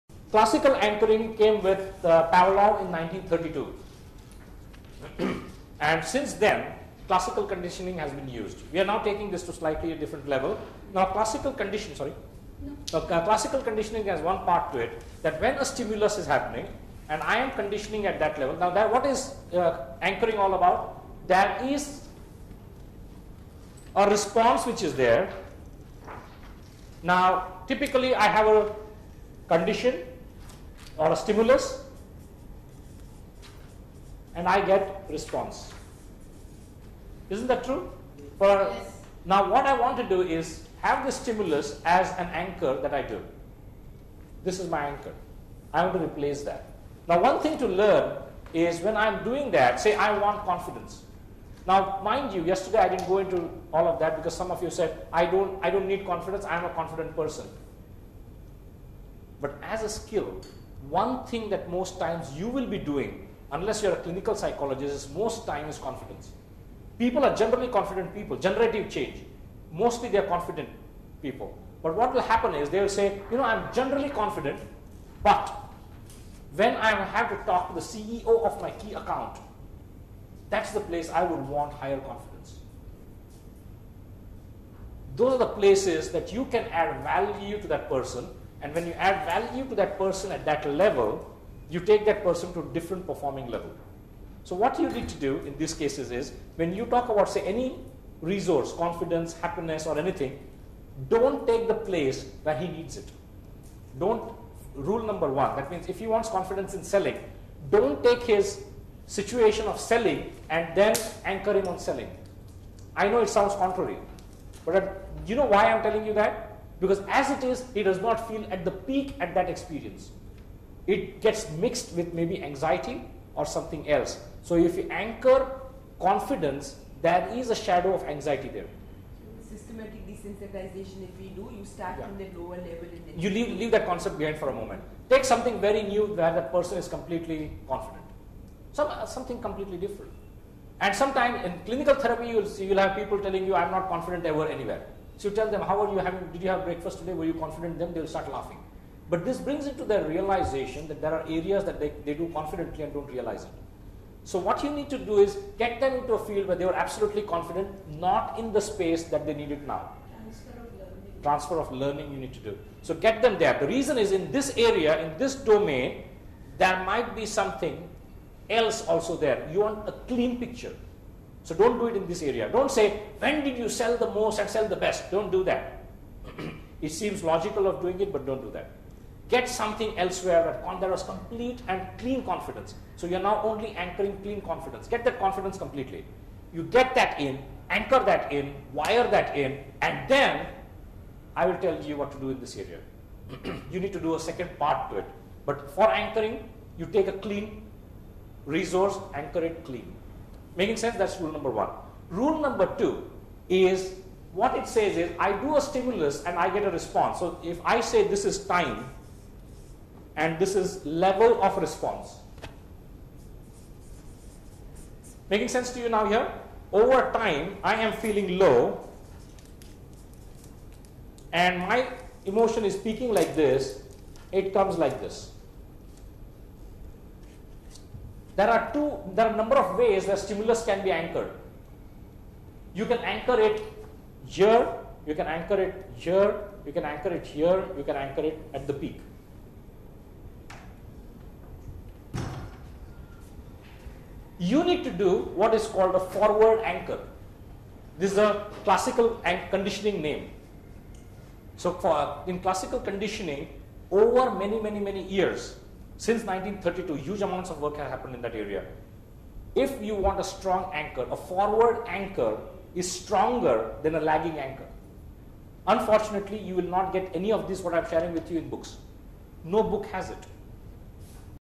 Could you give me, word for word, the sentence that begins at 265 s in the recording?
Unfortunately, you will not get any of this what I'm sharing with you in books.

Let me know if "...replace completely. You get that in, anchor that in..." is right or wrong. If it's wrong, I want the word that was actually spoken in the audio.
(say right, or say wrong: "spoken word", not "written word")
wrong: "confidence", not "replace".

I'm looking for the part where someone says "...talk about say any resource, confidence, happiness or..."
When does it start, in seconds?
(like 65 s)
96 s.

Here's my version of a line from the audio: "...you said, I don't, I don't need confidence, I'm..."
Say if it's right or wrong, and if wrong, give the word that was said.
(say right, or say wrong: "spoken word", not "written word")
right.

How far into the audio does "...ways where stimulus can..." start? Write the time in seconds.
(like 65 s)
229 s.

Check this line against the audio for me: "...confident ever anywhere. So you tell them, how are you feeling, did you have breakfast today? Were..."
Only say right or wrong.
wrong.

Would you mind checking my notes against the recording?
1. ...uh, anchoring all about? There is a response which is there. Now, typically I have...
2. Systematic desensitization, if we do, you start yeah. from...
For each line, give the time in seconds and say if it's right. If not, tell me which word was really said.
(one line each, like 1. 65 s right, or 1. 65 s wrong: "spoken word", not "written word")
1. 19 s right
2. 129 s right.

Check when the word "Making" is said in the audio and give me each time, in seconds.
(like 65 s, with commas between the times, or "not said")
200 s, 215 s.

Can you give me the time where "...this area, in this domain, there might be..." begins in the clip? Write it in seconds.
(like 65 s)
164 s.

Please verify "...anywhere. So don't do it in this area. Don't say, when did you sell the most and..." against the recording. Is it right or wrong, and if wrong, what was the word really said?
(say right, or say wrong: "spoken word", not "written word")
wrong: "picture", not "anywhere".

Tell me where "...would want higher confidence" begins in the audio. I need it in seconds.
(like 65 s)
81 s.